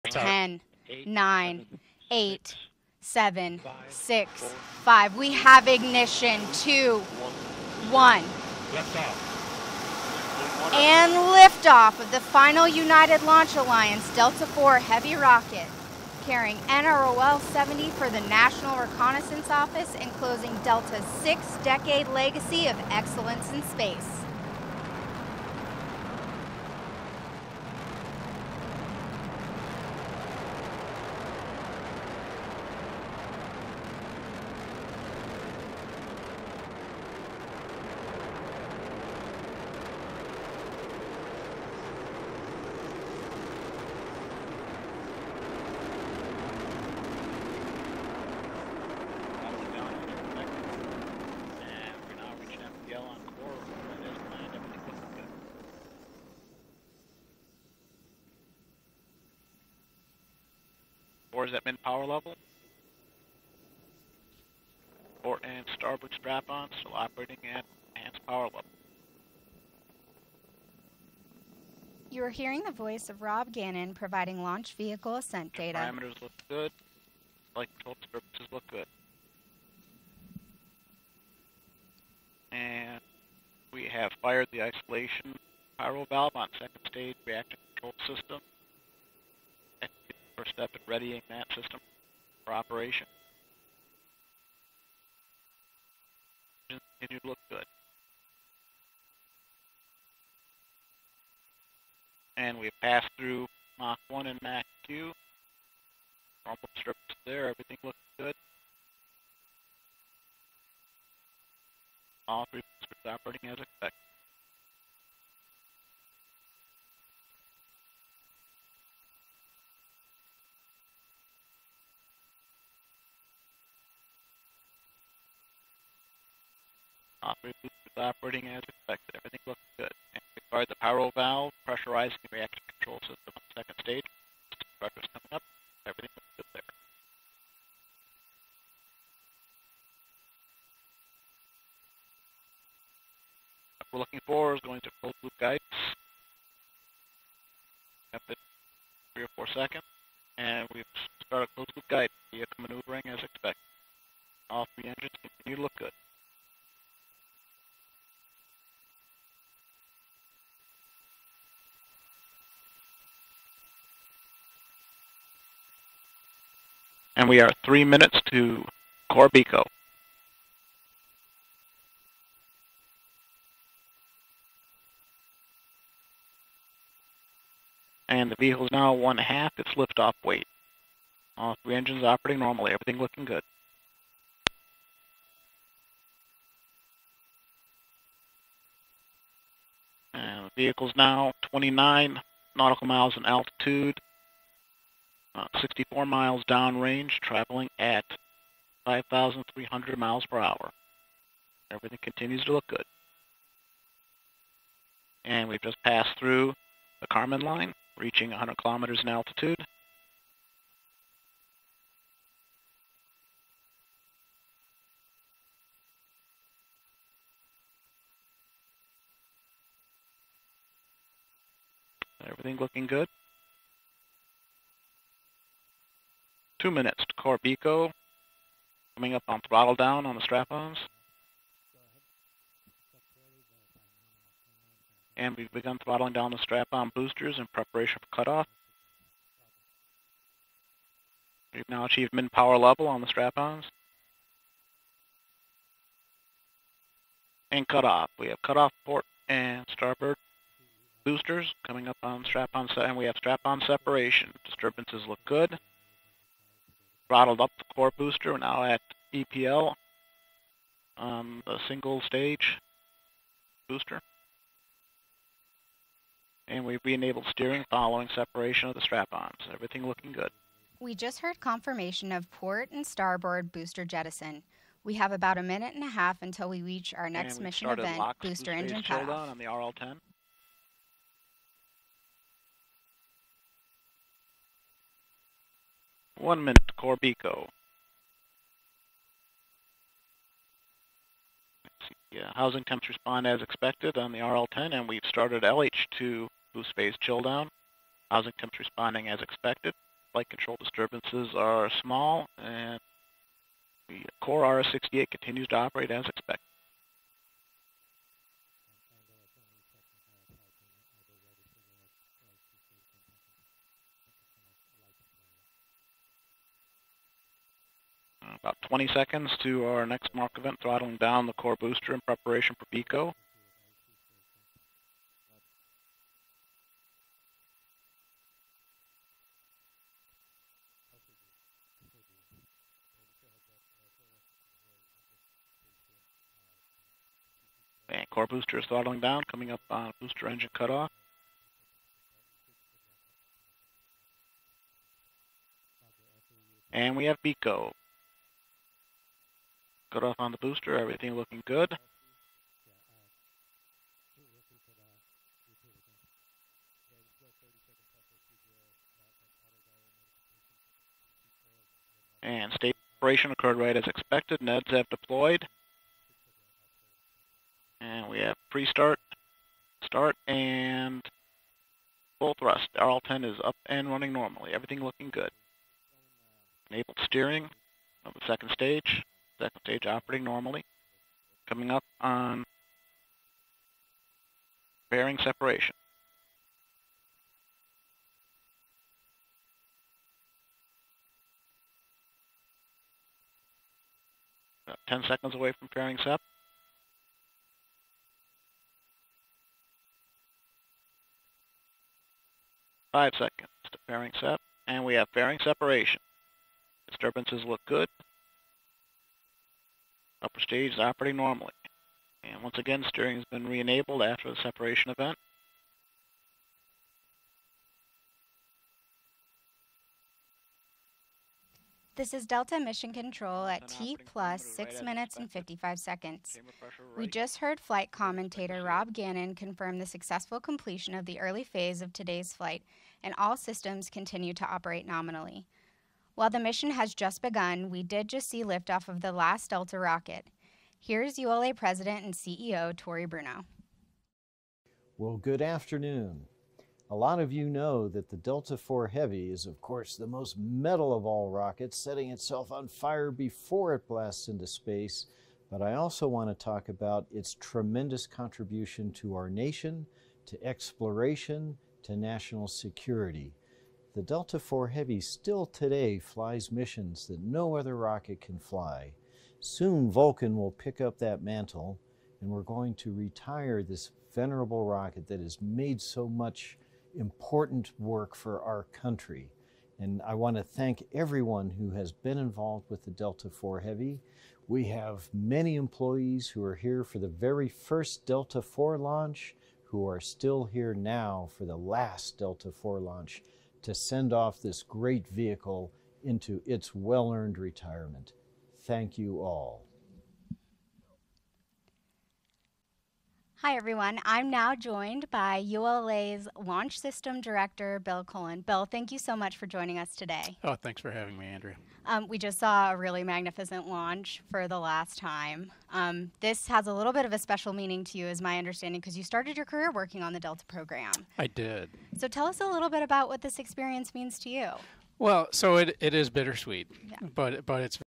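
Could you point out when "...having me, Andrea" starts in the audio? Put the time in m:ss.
8:30.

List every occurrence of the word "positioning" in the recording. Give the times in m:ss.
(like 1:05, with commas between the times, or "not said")
not said.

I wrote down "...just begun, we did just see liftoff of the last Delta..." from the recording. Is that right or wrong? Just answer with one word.
right.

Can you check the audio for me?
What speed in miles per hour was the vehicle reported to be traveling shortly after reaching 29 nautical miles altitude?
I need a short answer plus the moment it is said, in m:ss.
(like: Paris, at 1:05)
5,300, at 3:18.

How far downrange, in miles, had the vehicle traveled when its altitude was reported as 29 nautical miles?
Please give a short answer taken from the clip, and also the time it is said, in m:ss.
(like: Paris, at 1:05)
64 miles, at 3:15.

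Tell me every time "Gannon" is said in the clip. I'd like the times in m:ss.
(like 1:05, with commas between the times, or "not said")
1:13, 7:08.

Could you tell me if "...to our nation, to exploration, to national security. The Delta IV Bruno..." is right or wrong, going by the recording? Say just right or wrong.
wrong.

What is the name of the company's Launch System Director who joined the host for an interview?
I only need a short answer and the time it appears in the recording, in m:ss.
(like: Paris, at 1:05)
Bill Cullen, at 8:27.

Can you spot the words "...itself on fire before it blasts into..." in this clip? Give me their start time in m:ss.
7:32.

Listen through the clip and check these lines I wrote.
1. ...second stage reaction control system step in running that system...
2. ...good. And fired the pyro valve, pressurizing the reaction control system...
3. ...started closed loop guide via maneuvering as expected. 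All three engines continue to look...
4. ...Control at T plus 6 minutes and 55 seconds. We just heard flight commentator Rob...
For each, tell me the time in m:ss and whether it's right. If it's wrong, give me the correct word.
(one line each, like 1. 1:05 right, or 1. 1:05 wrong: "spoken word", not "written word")
1. 1:26 wrong: "readying", not "running"
2. 2:09 right
3. 2:31 right
4. 7:02 right.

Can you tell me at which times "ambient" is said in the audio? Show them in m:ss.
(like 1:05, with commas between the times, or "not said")
not said.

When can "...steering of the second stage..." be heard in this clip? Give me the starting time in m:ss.
6:17.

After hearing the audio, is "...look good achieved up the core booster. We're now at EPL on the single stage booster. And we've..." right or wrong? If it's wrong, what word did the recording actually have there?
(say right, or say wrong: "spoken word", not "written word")
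wrong: "throttled", not "achieved".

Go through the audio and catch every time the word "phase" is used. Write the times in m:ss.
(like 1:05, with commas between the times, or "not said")
4:56, 7:11.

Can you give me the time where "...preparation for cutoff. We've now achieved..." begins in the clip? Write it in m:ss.
3:57.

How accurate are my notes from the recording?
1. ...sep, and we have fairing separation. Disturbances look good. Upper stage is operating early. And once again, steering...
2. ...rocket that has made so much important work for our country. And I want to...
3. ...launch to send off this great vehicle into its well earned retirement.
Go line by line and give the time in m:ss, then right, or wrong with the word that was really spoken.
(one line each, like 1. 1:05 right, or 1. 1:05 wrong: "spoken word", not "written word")
1. 6:44 wrong: "normally", not "early"
2. 7:54 right
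3. 8:12 right.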